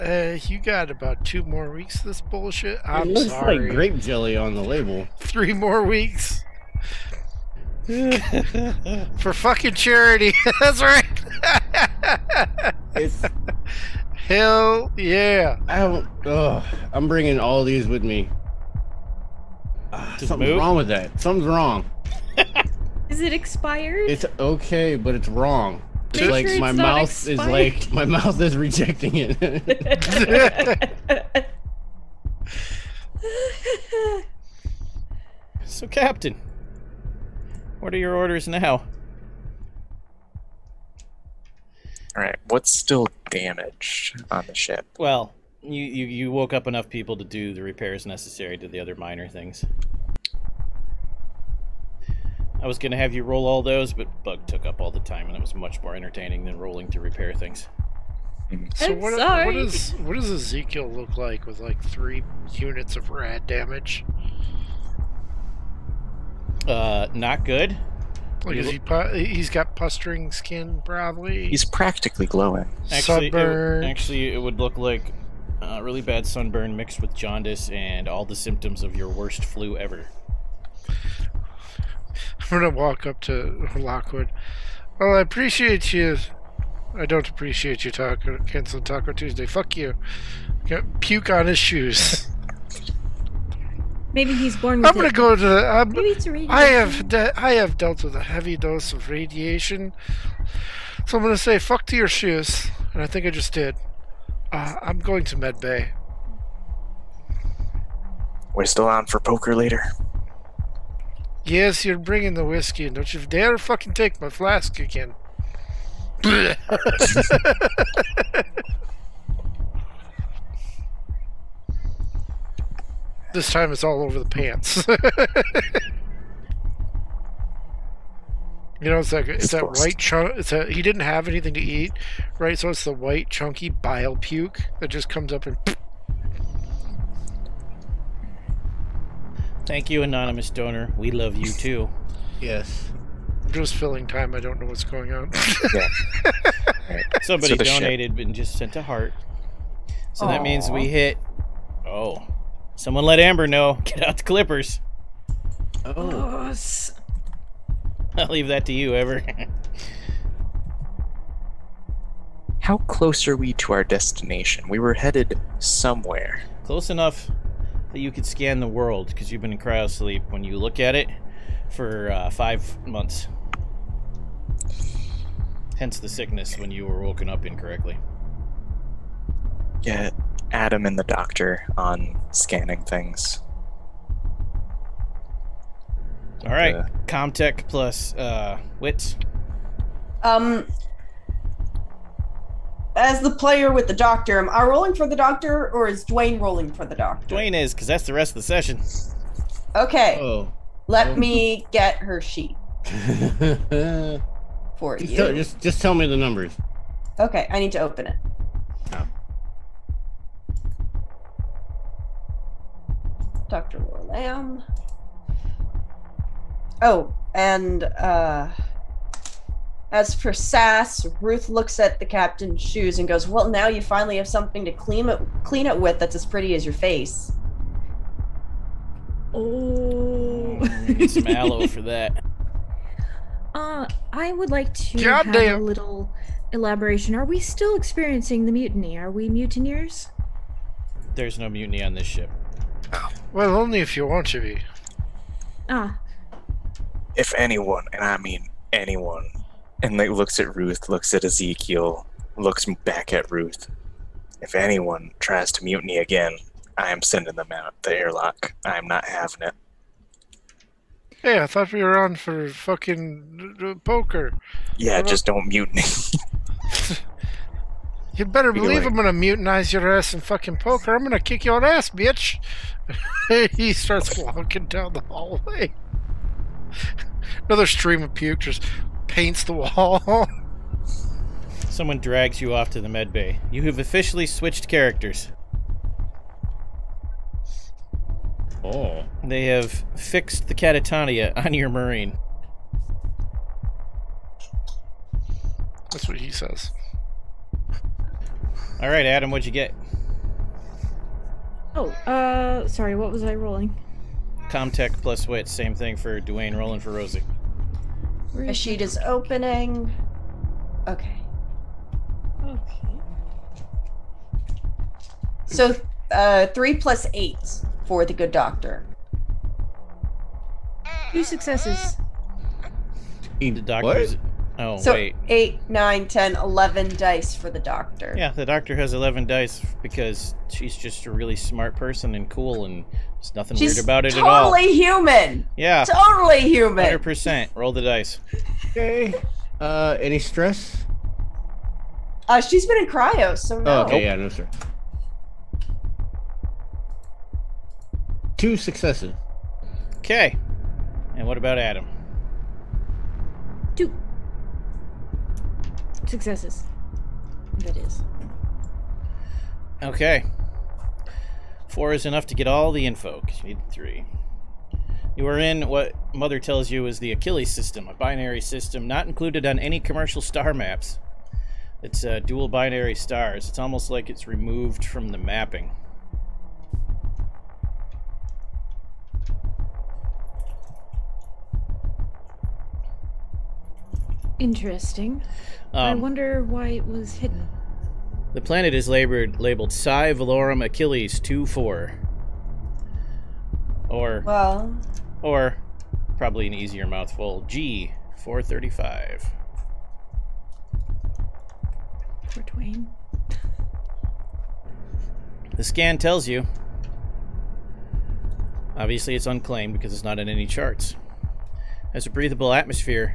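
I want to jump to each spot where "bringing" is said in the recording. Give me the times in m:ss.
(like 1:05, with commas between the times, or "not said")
0:17, 1:51.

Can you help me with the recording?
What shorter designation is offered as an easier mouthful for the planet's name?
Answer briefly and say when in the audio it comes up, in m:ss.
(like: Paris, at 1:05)
G 435, at 6:37.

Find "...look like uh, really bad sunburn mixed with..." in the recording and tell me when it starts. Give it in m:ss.
1:14.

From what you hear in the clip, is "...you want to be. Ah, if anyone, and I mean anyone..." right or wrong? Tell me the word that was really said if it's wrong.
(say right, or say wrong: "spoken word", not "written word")
right.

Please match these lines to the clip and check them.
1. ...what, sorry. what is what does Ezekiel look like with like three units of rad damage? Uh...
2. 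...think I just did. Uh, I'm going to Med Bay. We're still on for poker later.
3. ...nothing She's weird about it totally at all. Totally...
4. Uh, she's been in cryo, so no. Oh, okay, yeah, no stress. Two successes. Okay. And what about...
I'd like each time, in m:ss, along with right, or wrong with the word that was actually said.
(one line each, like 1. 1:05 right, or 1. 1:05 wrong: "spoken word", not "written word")
1. 0:59 right
2. 1:43 right
3. 5:33 right
4. 5:42 right.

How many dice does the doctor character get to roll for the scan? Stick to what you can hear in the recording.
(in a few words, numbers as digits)
11.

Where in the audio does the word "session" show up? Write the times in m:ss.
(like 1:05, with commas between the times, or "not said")
3:18.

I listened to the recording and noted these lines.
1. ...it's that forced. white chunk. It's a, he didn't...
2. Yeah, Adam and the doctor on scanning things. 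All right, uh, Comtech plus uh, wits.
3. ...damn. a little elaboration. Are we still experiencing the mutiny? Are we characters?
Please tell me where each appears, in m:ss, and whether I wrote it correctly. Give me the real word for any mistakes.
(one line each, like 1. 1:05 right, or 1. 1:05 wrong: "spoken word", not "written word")
1. 2:09 right
2. 2:59 right
3. 3:55 wrong: "mutineers", not "characters".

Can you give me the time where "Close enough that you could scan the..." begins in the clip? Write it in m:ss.
2:46.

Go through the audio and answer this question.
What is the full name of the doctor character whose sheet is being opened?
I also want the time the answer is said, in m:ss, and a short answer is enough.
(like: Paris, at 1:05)
Dr. Laura Lamb, at 3:33.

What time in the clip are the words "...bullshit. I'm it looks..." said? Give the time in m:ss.
0:02.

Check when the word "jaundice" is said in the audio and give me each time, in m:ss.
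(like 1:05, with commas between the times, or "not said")
1:17.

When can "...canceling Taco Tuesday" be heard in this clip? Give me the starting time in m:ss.
1:28.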